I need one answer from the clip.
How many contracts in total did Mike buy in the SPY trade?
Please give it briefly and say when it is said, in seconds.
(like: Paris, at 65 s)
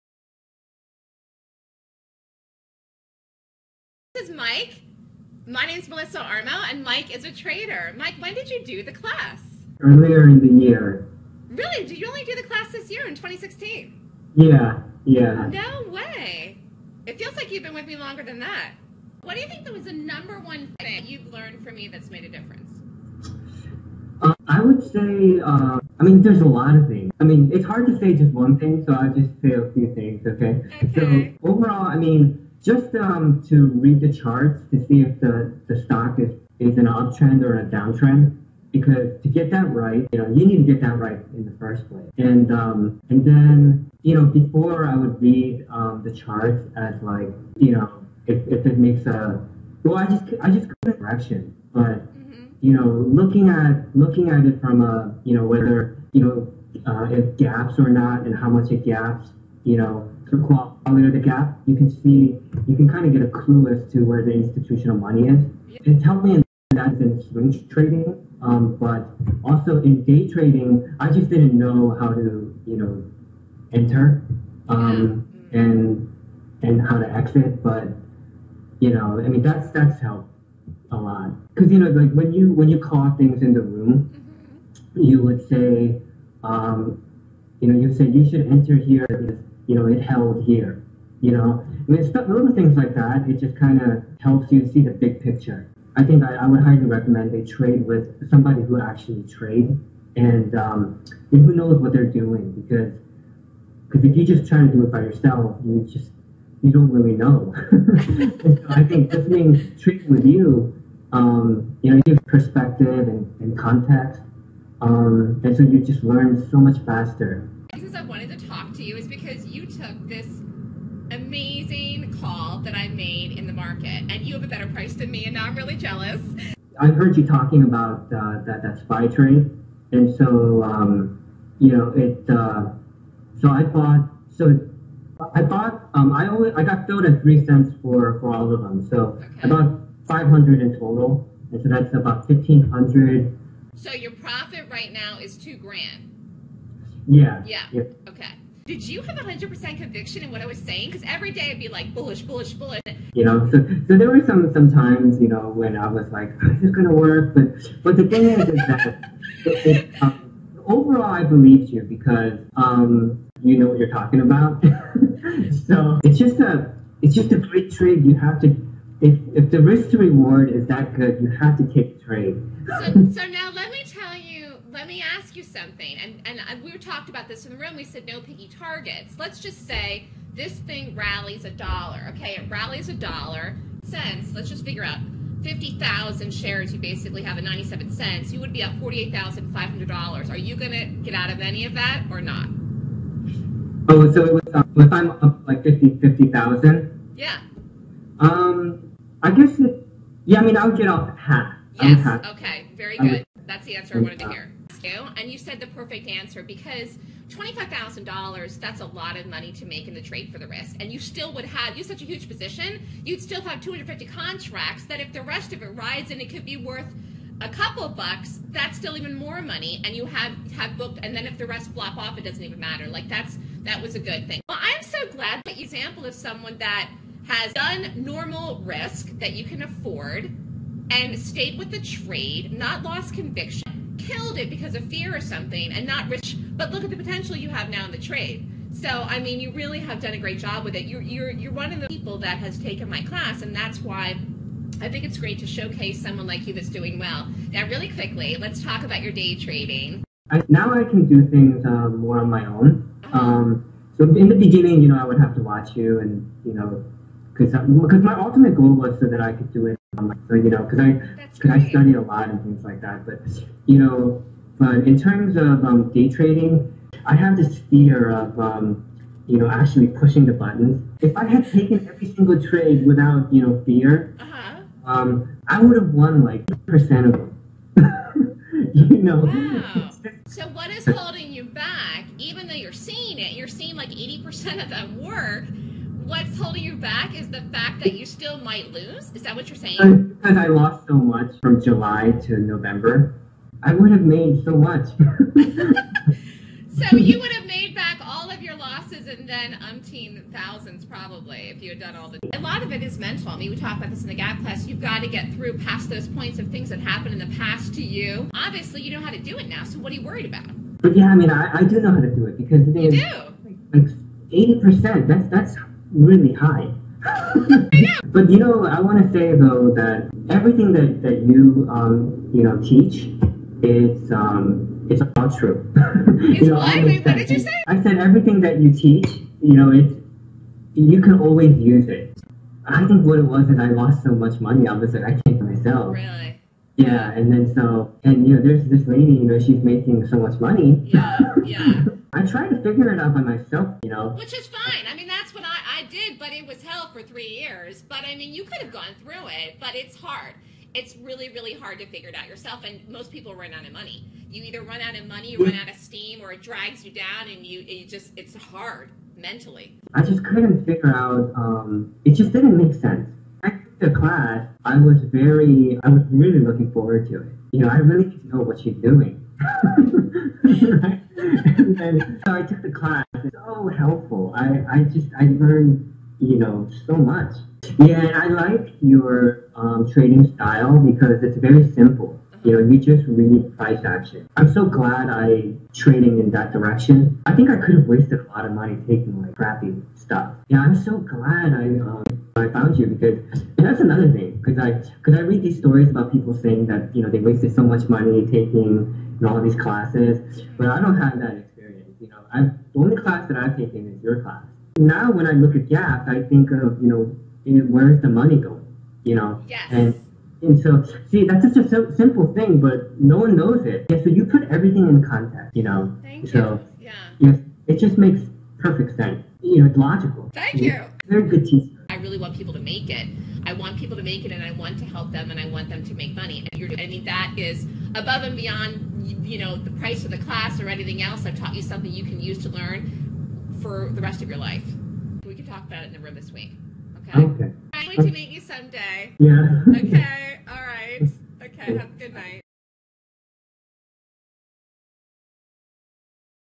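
500, at 140 s.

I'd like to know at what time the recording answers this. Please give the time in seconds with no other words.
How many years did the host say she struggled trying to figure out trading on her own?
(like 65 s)
347 s.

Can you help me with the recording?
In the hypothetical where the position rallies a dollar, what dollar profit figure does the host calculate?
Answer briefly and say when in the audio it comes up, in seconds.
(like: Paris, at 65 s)
$48,500, at 188 s.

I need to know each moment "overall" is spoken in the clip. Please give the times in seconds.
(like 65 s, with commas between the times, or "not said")
31 s, 160 s.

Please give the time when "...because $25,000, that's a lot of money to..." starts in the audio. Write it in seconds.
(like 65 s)
206 s.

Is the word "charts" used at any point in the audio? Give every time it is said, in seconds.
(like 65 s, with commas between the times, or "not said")
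34 s, 46 s.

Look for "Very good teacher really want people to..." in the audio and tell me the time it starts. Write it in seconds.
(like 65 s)
421 s.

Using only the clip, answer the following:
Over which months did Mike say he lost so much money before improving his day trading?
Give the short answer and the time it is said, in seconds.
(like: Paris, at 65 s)
July to November, at 291 s.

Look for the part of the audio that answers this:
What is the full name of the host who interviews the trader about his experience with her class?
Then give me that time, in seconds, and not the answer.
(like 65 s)
5 s.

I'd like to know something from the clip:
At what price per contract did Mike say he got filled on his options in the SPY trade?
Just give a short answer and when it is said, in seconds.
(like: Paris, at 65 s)
3 cents, at 137 s.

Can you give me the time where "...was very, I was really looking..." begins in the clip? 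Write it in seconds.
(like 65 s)
364 s.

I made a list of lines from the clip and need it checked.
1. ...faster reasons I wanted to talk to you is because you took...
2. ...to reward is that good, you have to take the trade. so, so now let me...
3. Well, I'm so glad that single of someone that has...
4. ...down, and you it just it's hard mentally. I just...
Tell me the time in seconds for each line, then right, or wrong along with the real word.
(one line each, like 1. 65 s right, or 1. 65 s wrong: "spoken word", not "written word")
1. 116 s right
2. 169 s right
3. 224 s wrong: "example", not "single"
4. 356 s right.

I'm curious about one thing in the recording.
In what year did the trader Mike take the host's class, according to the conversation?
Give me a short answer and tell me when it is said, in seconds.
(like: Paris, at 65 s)
2016, at 13 s.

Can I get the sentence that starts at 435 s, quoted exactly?
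We can talk about it in the room this week.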